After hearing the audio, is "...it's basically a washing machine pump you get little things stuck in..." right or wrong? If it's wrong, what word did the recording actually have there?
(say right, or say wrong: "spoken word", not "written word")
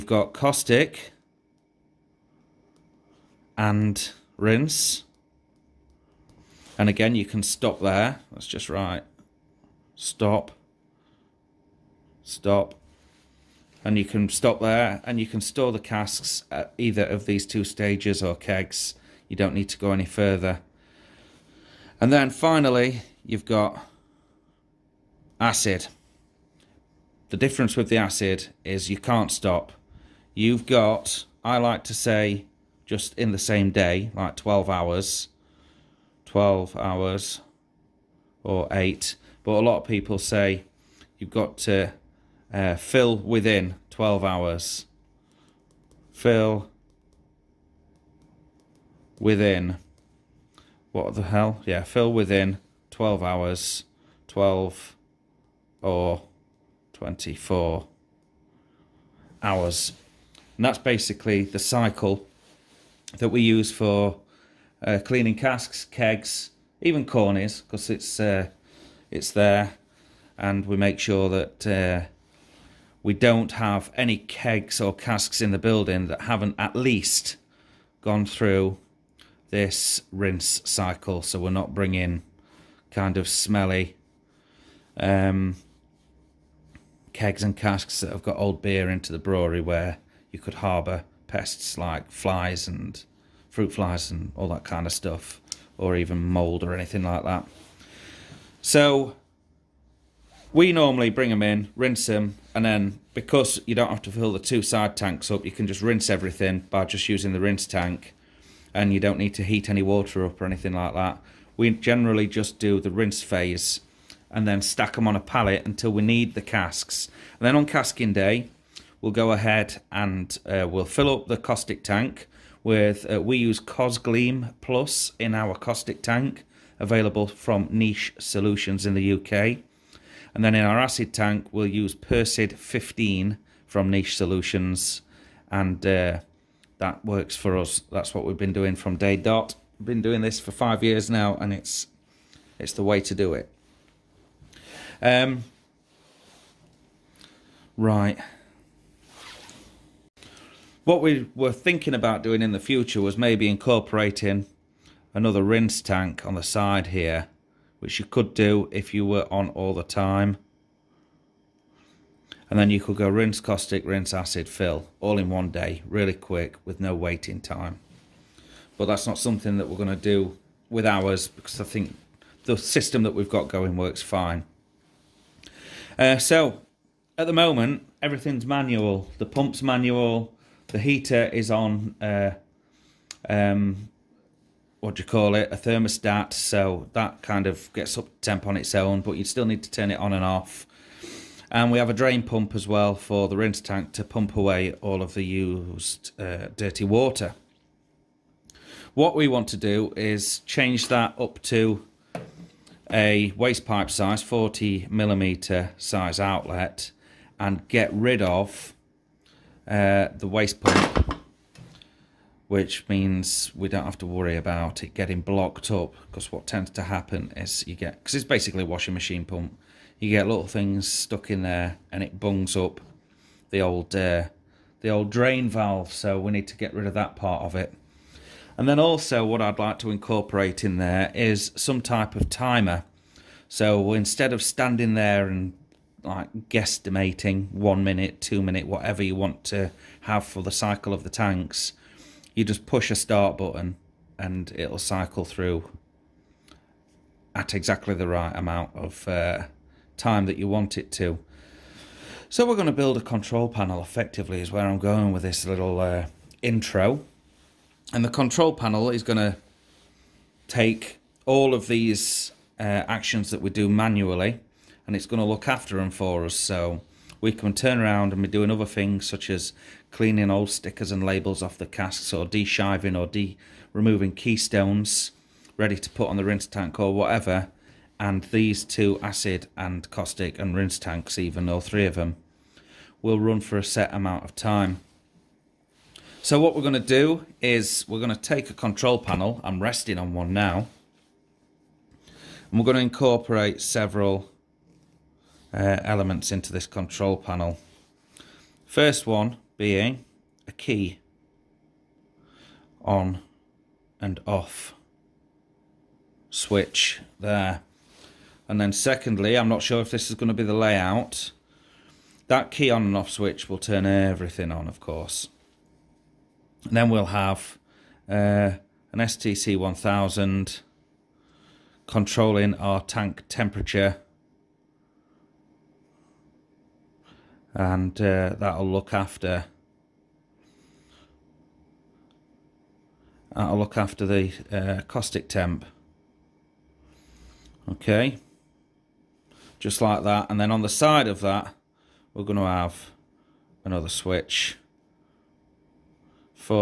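right.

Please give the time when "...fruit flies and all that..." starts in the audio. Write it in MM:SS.
01:33.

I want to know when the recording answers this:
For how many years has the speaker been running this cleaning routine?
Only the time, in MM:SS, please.
02:20.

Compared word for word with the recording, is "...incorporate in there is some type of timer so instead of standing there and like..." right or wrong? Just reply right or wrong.
right.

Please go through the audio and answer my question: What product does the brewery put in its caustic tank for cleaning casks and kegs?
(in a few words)
Cosgleam Plus.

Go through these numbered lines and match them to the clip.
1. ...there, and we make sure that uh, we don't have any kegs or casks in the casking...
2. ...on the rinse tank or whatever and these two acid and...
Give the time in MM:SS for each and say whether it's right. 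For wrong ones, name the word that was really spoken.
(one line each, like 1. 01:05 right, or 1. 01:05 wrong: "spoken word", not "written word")
1. 01:09 wrong: "building", not "casking"
2. 04:36 right.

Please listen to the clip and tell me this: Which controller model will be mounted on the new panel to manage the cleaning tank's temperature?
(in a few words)
STC 1000.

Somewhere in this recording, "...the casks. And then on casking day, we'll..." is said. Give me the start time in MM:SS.
01:56.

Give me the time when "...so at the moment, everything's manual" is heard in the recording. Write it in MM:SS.
02:56.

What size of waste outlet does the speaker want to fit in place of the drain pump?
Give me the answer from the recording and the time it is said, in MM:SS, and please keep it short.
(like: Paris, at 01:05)
40 millimeter, at 03:24.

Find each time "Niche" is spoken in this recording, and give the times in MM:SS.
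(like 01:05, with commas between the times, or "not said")
02:07, 02:13.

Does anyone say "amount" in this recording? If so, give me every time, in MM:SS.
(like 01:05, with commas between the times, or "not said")
04:08, 04:43.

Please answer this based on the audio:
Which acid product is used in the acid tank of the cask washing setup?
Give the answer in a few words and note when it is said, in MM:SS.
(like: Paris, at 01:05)
Persid 15, at 02:11.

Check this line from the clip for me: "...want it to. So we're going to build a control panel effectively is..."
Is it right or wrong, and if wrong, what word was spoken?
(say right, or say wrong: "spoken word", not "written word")
right.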